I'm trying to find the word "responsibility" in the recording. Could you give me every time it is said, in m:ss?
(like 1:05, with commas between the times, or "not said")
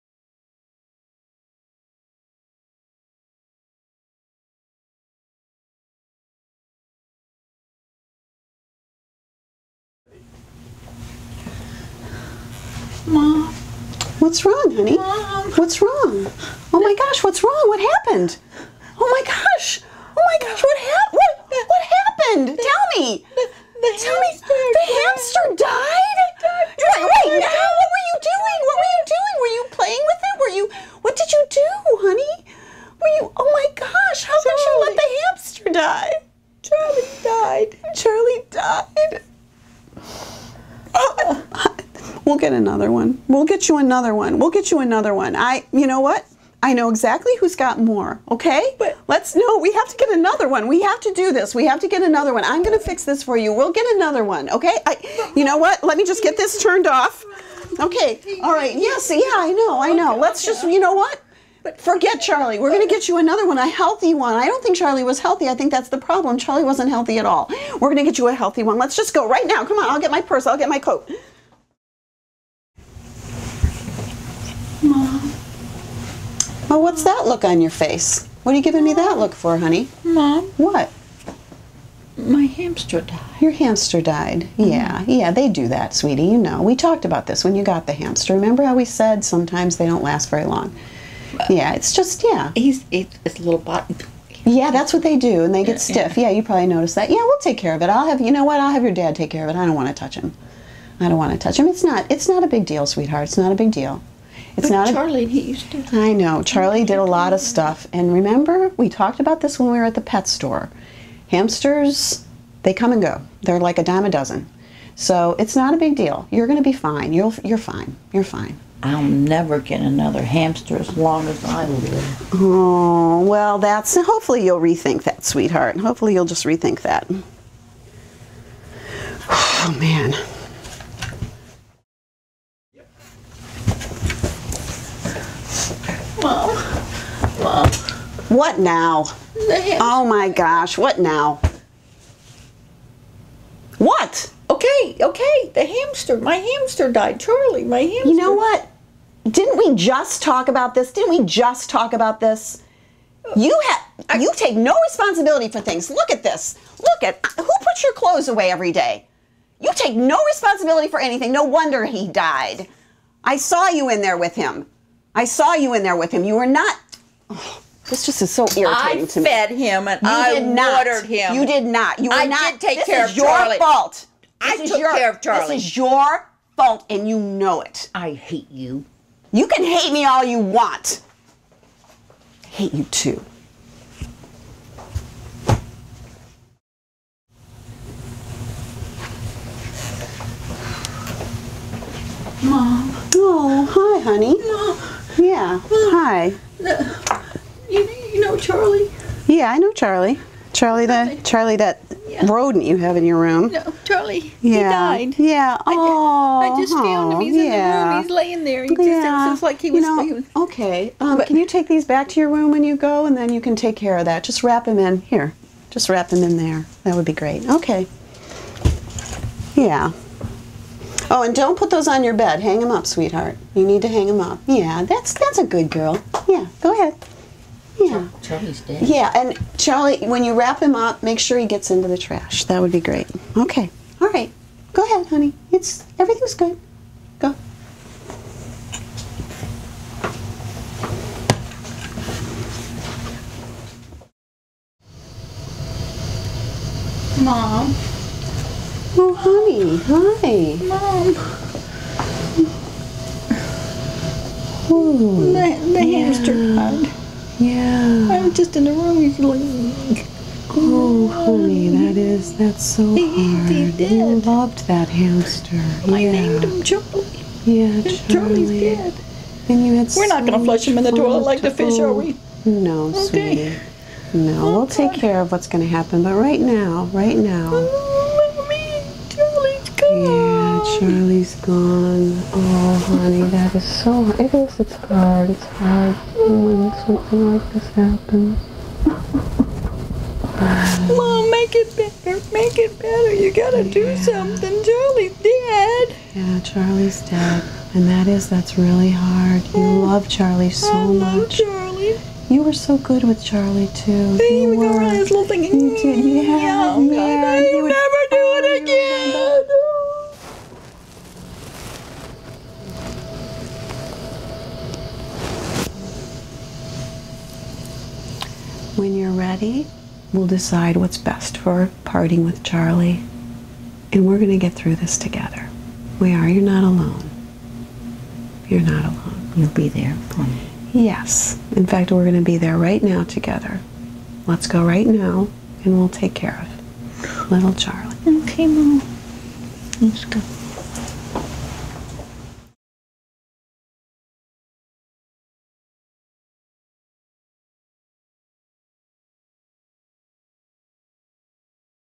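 2:34, 2:40.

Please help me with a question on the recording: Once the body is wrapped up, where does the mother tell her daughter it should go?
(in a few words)
the trash.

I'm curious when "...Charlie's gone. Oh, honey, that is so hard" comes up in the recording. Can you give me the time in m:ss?
4:40.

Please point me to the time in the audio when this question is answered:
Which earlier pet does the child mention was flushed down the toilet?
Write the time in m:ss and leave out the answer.
4:31.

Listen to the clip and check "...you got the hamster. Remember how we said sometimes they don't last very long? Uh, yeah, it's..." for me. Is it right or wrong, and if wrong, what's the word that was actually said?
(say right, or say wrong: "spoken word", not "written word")
right.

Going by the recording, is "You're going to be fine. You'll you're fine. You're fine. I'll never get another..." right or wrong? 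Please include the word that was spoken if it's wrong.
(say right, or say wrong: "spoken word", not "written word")
right.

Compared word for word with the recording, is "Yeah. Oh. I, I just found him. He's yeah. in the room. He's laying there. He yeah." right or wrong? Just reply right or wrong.
right.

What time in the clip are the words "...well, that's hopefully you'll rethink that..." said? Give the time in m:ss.
2:03.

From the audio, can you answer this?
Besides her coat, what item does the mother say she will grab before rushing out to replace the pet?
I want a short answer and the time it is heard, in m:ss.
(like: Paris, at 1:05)
purse, at 1:10.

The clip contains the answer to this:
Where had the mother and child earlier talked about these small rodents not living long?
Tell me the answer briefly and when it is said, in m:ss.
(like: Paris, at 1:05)
the pet store, at 1:50.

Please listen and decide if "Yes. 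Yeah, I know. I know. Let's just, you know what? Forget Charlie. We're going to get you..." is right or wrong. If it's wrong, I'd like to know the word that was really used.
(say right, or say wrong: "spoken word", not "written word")
right.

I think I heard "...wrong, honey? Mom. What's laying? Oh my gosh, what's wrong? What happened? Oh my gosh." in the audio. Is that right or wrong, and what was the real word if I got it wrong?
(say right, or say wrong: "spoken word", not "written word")
wrong: "wrong", not "laying".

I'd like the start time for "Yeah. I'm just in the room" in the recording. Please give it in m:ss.
4:17.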